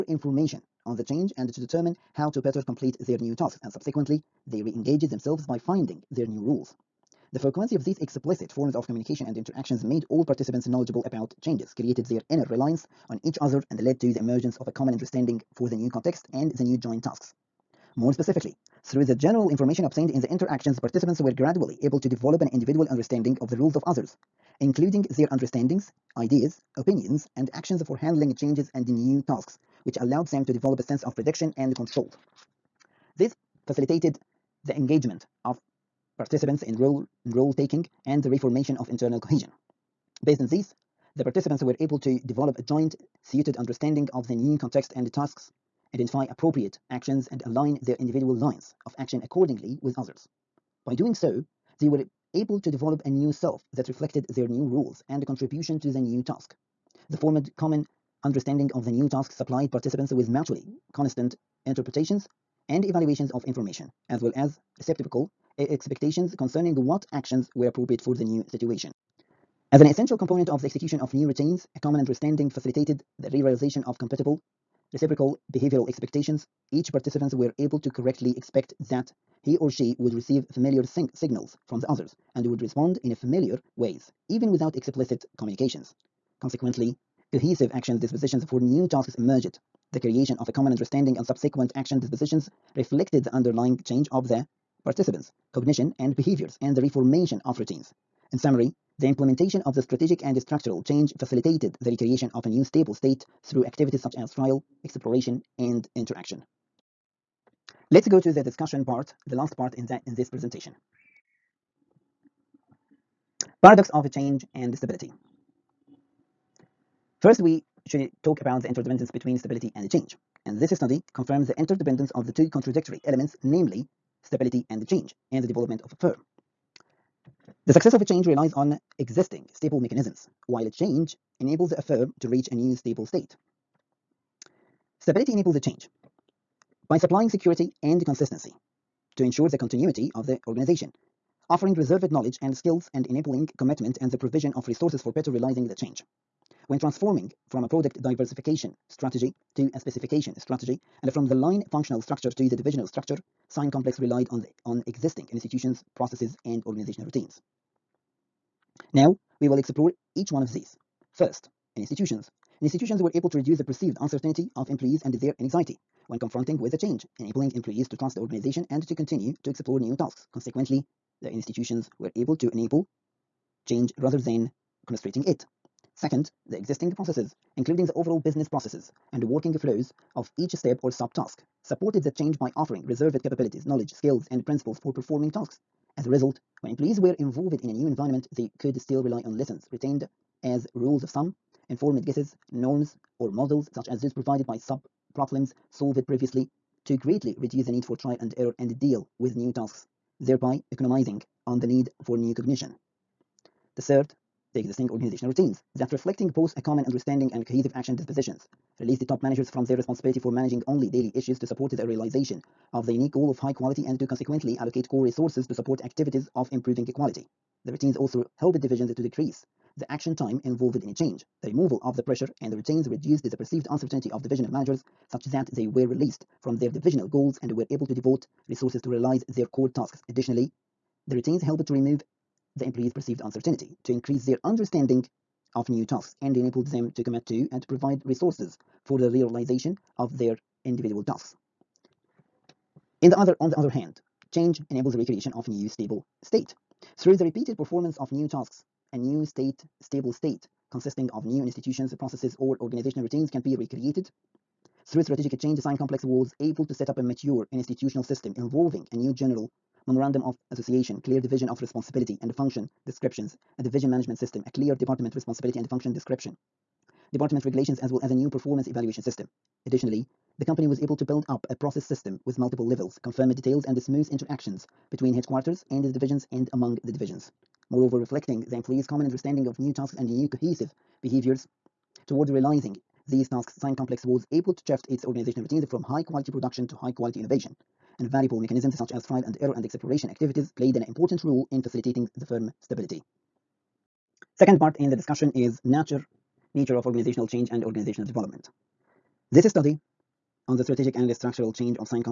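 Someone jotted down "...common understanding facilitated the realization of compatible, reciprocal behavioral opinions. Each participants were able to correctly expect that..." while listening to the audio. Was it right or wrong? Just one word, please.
wrong.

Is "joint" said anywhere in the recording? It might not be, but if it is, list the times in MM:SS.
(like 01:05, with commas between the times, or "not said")
00:16, 00:42.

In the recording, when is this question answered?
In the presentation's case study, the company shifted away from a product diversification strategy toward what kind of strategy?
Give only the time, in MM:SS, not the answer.
02:29.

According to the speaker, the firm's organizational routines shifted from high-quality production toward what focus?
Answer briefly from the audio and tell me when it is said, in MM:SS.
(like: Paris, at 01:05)
high-quality innovation, at 04:46.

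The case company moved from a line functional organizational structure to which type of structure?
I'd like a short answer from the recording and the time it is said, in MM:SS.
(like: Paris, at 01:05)
divisional structure, at 02:32.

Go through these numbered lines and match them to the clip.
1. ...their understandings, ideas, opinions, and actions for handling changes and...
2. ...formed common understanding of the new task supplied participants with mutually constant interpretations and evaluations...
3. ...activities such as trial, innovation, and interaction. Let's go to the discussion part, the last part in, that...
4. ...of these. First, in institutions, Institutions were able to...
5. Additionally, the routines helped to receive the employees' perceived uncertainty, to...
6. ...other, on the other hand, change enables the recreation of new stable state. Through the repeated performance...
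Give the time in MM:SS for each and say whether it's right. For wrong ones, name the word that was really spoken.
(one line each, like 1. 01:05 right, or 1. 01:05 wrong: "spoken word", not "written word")
1. 00:25 right
2. 00:57 right
3. 01:43 wrong: "exploration", not "innovation"
4. 02:40 right
5. 03:50 wrong: "remove", not "receive"
6. 04:03 right.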